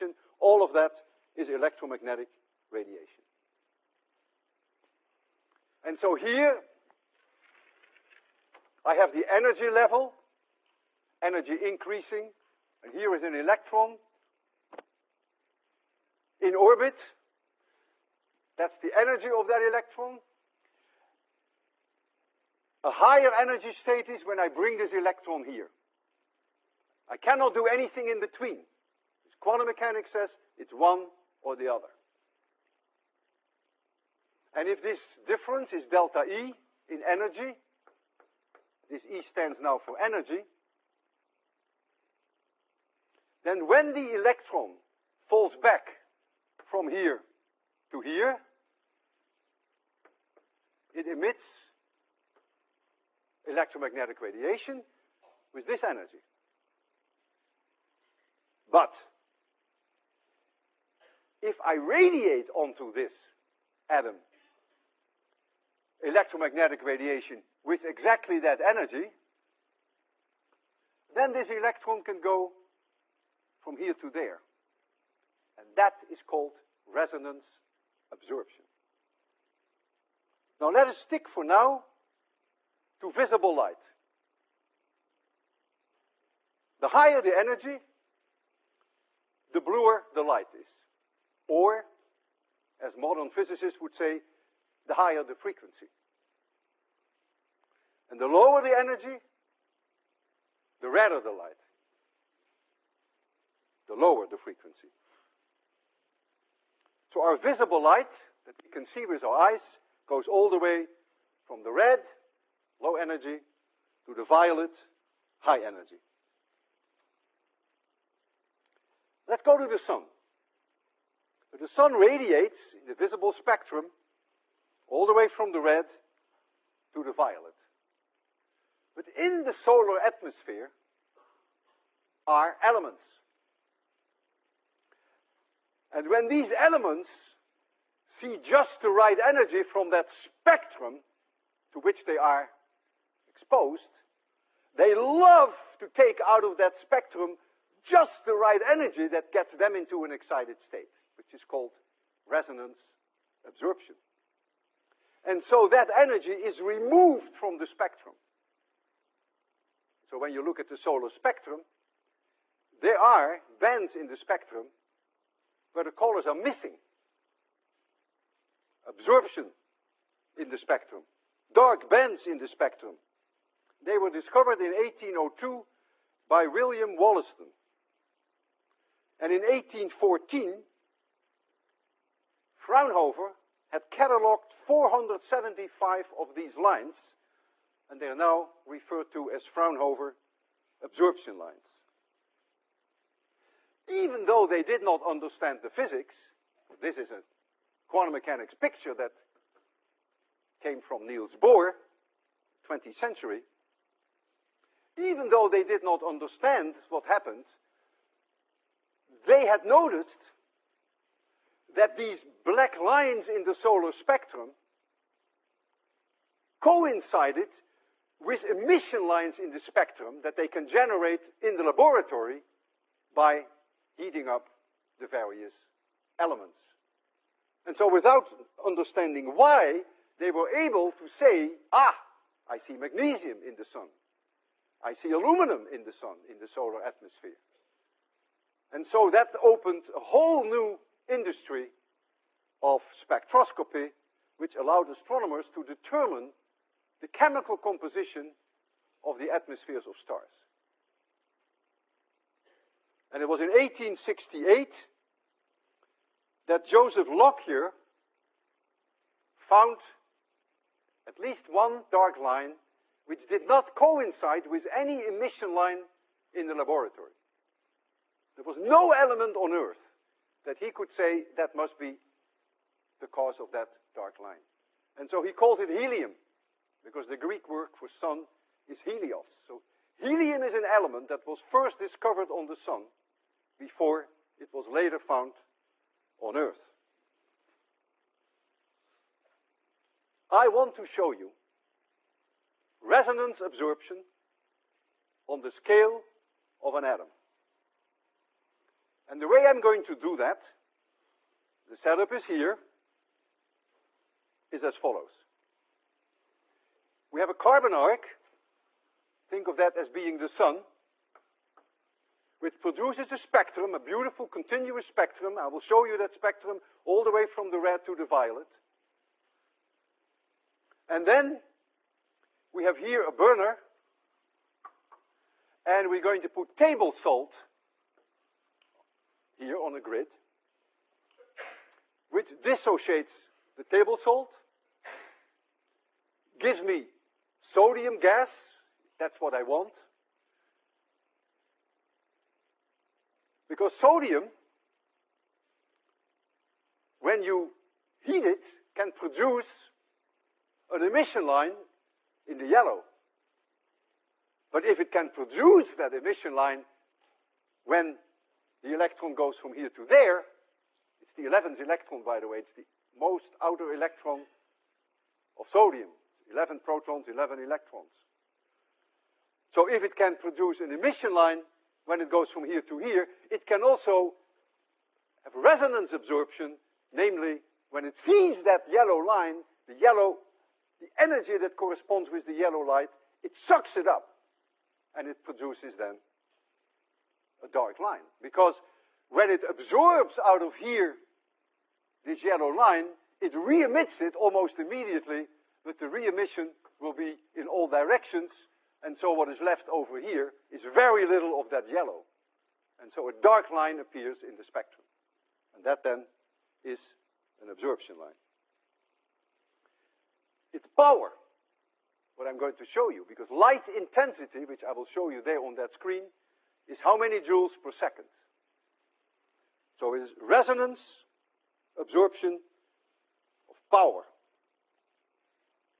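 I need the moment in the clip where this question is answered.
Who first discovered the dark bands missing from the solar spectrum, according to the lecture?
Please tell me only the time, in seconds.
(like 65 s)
176 s.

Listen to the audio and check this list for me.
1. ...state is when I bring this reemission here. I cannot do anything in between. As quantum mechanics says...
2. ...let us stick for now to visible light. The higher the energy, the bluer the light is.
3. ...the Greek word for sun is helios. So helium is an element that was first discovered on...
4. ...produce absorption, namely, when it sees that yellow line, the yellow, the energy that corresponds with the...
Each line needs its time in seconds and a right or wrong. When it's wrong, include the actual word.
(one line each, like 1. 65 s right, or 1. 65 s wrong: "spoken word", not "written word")
1. 23 s wrong: "electron", not "reemission"
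2. 80 s right
3. 277 s right
4. 375 s wrong: "resonance", not "produce".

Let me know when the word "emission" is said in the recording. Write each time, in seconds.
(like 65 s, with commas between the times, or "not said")
218 s, 265 s, 350 s, 355 s, 370 s, 395 s.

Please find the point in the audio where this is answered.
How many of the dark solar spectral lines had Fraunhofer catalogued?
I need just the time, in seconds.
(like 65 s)
184 s.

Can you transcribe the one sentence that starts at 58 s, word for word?
But if I radiate onto this atom electromagnetic radiation with exactly that energy, then this electron can go from here to there.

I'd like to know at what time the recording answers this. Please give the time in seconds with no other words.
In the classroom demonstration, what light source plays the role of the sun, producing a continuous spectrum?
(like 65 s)
307 s.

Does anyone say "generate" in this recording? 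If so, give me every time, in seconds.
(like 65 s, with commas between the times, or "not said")
220 s.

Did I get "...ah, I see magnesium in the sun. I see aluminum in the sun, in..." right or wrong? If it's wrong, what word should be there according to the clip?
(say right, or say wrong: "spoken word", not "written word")
right.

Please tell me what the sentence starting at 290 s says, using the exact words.
I want to show you resonance absorption on the scale of an atom.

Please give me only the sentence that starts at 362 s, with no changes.
It's the most outer electron of sodium.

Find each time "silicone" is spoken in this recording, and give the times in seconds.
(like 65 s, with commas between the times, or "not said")
not said.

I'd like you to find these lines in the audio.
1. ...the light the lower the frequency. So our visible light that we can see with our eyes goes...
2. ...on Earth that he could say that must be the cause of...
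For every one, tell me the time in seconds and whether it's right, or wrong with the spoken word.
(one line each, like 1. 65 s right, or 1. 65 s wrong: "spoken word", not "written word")
1. 101 s right
2. 269 s right.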